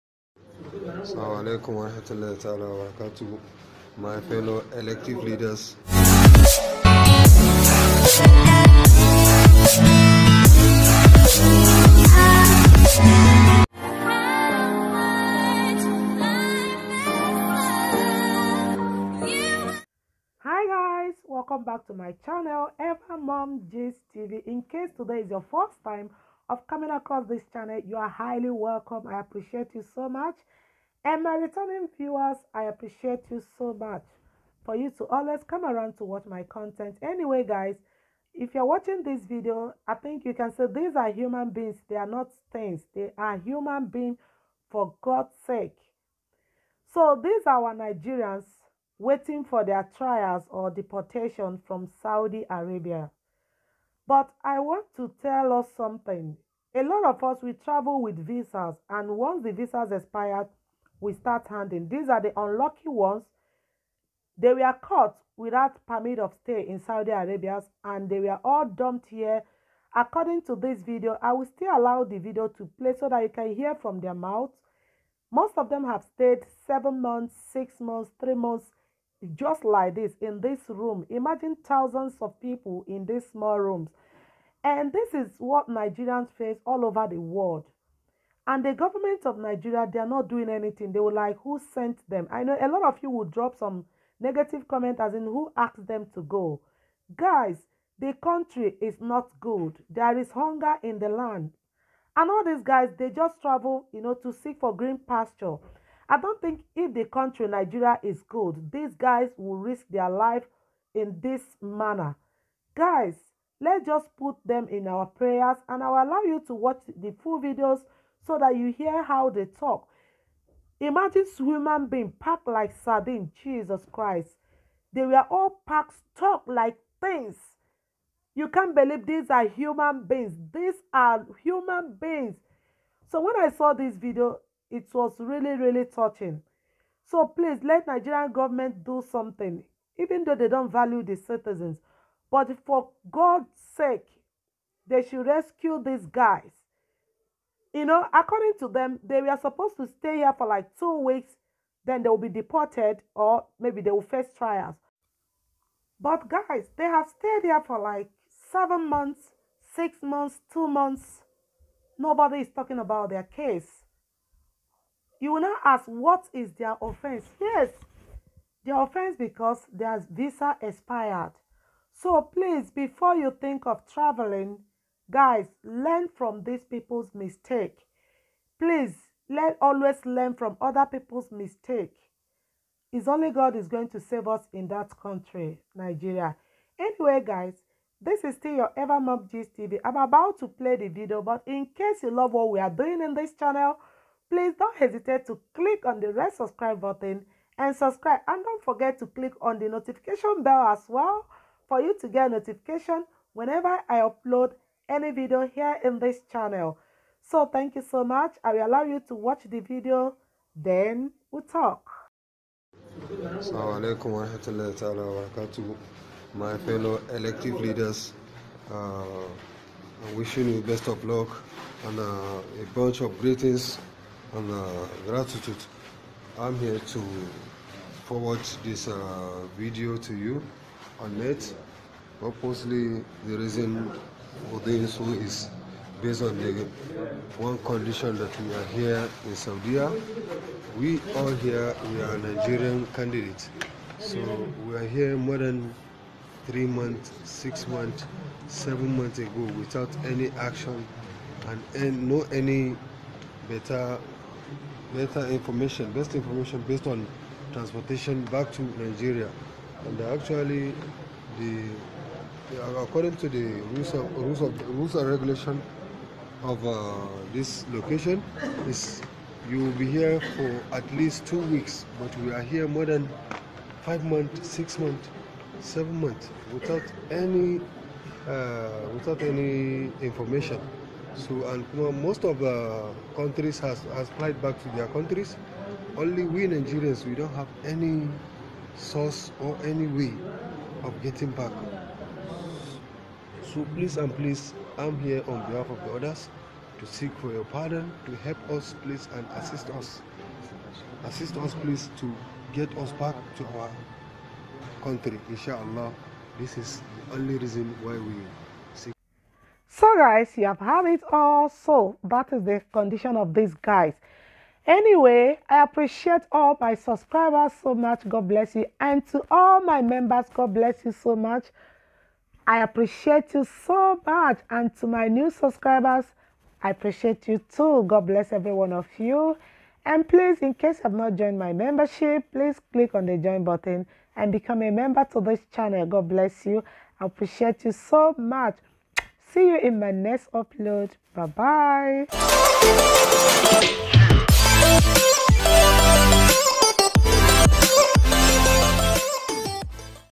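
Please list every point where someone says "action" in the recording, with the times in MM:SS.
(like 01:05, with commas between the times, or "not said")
04:10.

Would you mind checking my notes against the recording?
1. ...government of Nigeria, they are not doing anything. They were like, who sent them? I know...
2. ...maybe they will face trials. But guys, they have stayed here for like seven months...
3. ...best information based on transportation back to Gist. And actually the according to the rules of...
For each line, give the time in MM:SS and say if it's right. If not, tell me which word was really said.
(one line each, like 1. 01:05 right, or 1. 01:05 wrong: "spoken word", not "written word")
1. 01:28 right
2. 02:33 right
3. 04:15 wrong: "Nigeria", not "Gist".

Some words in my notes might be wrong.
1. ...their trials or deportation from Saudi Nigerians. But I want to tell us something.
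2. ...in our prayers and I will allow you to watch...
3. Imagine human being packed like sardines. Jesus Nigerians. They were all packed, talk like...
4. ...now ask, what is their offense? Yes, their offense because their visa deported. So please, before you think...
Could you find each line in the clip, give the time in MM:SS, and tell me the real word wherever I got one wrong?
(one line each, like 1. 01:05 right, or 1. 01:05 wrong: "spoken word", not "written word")
1. 00:49 wrong: "Arabia", not "Nigerians"
2. 01:54 right
3. 02:00 wrong: "Christ", not "Nigerians"
4. 02:45 wrong: "expired", not "deported".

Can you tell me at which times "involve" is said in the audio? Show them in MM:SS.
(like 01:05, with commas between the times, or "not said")
not said.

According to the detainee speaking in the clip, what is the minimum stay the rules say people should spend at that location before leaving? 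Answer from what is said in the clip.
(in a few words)
2 weeks.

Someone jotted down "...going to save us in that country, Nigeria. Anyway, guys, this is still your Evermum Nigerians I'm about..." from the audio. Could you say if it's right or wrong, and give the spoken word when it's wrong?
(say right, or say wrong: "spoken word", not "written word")
wrong: "Gist", not "Nigerians".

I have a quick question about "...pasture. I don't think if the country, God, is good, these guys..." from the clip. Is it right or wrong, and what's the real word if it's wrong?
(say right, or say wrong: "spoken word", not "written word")
wrong: "Nigeria", not "God".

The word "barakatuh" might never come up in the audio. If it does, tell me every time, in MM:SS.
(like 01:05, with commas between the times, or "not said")
00:02, 03:35.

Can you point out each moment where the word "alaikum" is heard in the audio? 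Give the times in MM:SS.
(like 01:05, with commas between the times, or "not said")
00:01, 03:33.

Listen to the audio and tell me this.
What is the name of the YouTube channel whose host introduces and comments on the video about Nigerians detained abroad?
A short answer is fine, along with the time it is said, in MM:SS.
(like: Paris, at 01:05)
Evermum gist tv, at 00:22.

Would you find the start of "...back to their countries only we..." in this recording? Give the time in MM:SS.
04:44.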